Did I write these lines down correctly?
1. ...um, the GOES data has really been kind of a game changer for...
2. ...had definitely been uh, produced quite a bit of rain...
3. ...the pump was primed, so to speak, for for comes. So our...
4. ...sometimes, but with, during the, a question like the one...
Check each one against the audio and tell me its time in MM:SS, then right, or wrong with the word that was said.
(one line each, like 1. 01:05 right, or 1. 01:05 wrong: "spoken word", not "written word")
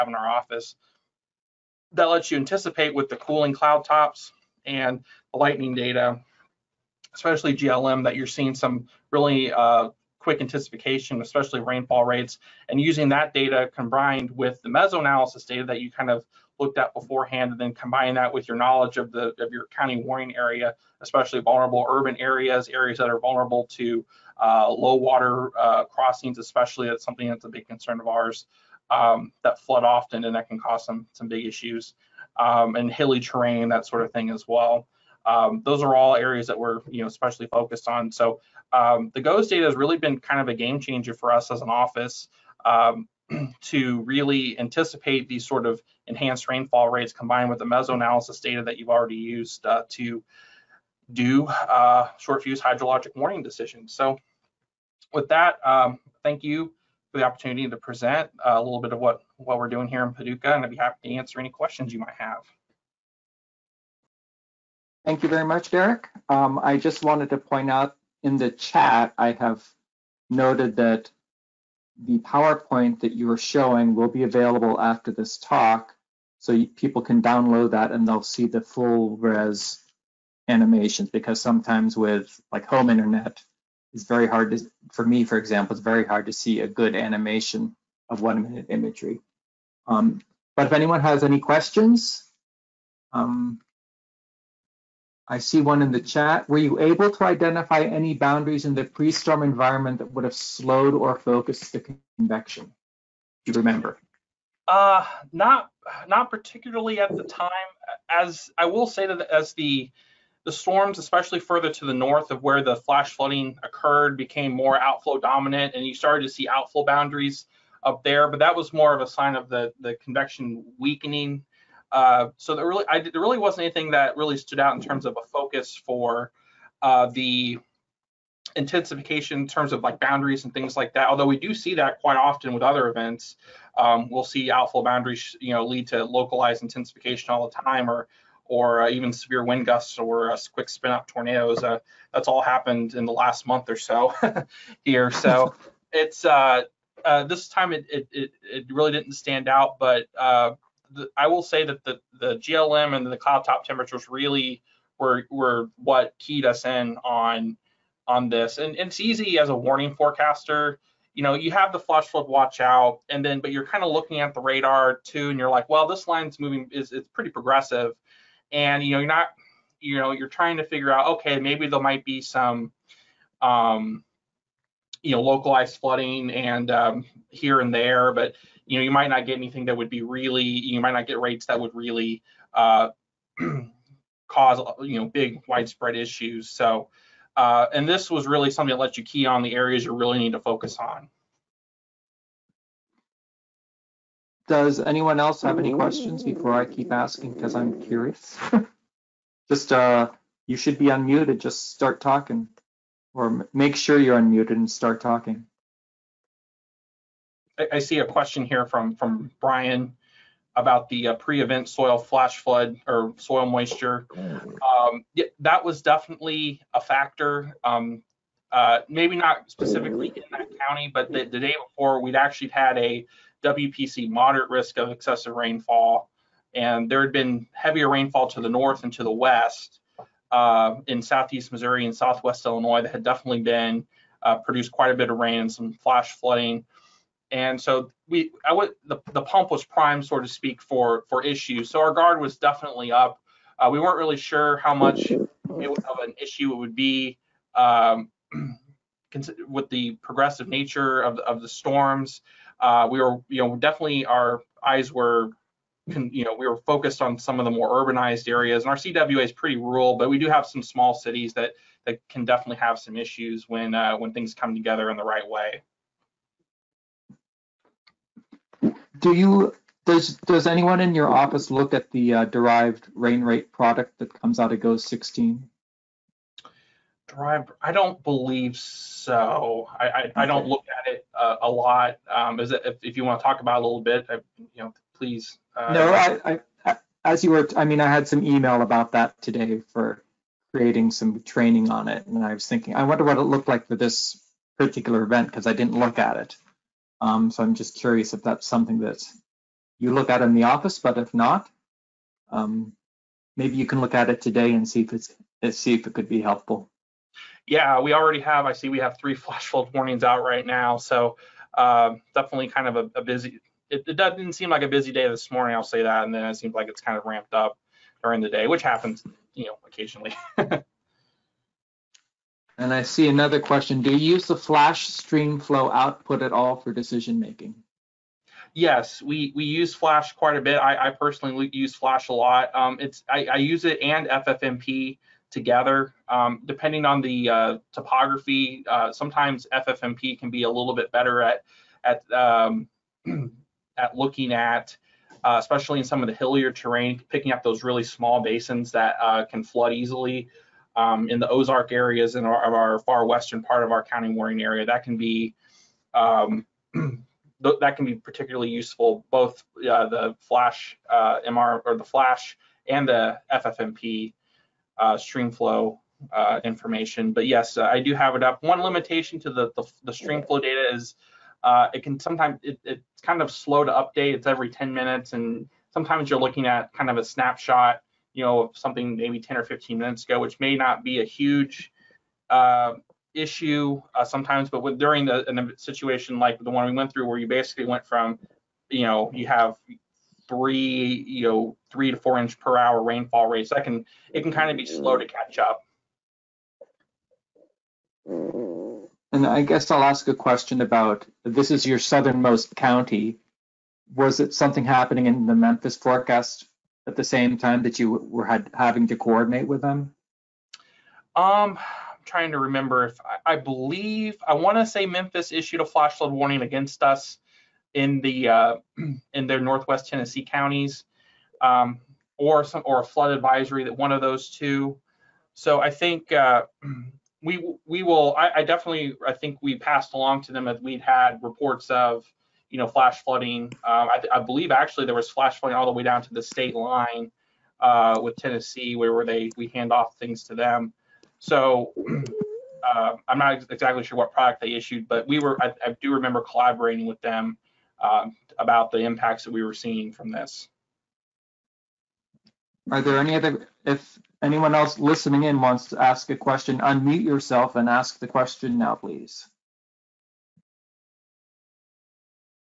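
1. 00:38 right
2. 03:52 right
3. 03:59 wrong: "issues", not "comes"
4. 06:24 wrong: "situation", not "question".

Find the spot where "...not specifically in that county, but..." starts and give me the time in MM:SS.
03:39.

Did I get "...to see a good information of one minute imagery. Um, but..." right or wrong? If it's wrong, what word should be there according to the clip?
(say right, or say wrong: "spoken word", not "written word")
wrong: "animation", not "information".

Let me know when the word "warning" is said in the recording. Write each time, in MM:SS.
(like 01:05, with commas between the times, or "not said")
00:19, 00:53, 02:39, 05:09, 06:56.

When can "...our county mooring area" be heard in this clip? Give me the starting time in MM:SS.
05:53.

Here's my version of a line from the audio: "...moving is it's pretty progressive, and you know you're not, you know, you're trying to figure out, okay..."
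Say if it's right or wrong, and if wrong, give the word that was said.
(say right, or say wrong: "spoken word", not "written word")
right.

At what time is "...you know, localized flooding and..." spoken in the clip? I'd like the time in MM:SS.
02:55.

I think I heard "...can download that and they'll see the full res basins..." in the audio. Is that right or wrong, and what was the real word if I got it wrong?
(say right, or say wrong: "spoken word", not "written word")
wrong: "animations", not "basins".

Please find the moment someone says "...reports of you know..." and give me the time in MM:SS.
07:11.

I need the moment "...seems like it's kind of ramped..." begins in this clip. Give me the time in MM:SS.
05:16.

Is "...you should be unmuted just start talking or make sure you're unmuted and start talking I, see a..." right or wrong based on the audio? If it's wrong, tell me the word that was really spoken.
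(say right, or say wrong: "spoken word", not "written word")
right.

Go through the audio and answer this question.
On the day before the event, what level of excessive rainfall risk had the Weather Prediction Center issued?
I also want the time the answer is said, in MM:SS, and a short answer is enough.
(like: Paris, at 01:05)
Moderate risk, at 03:44.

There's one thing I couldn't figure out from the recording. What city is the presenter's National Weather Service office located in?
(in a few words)
Paducah.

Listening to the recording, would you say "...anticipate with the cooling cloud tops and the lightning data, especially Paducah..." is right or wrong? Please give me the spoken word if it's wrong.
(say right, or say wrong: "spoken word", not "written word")
wrong: "GLM", not "Paducah".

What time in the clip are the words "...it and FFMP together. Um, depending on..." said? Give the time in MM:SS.
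05:33.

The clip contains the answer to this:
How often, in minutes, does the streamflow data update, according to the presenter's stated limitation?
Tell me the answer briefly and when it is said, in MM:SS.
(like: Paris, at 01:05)
10 minutes, at 06:14.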